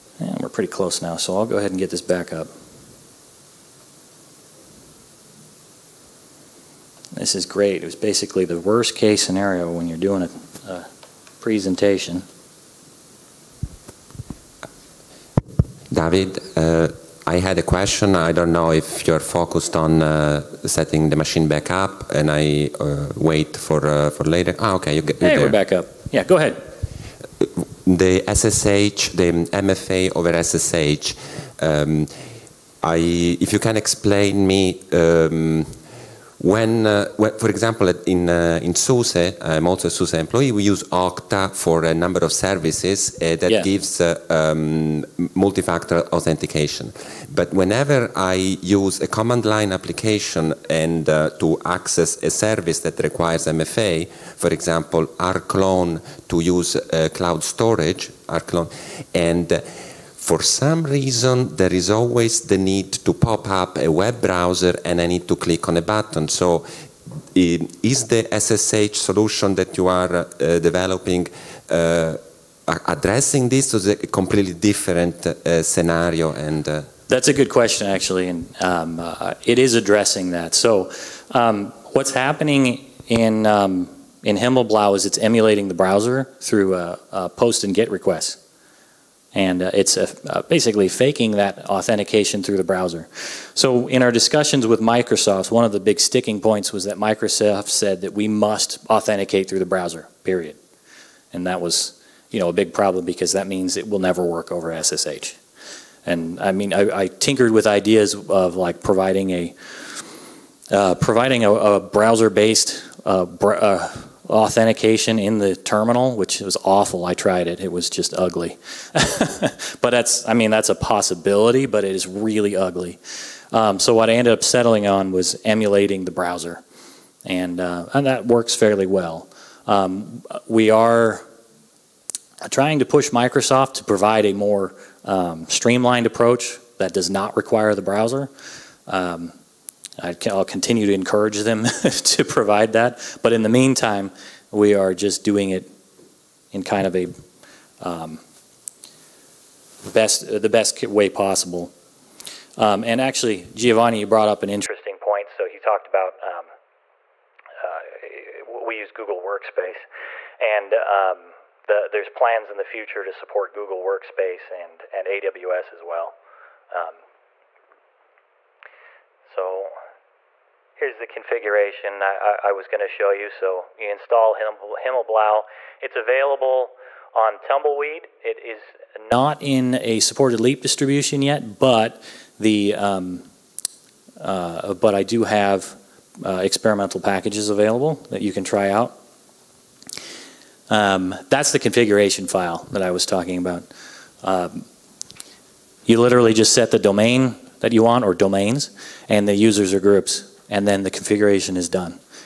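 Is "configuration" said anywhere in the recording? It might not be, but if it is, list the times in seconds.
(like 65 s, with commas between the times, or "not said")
171 s, 191 s, 200 s.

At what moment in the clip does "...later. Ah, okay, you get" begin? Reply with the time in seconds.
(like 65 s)
24 s.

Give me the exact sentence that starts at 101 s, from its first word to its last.
And that was, you know, a big problem because that means it will never work over SSH.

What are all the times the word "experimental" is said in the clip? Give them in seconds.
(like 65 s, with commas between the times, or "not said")
186 s.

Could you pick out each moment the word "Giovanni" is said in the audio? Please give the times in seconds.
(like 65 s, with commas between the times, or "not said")
153 s.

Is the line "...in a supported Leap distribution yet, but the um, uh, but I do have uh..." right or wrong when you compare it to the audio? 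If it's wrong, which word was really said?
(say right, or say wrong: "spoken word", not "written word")
right.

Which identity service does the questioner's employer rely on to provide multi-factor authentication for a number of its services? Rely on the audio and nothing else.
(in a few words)
Okta.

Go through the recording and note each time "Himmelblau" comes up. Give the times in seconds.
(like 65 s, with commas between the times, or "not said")
84 s, 174 s.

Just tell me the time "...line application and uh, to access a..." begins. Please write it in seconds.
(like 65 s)
49 s.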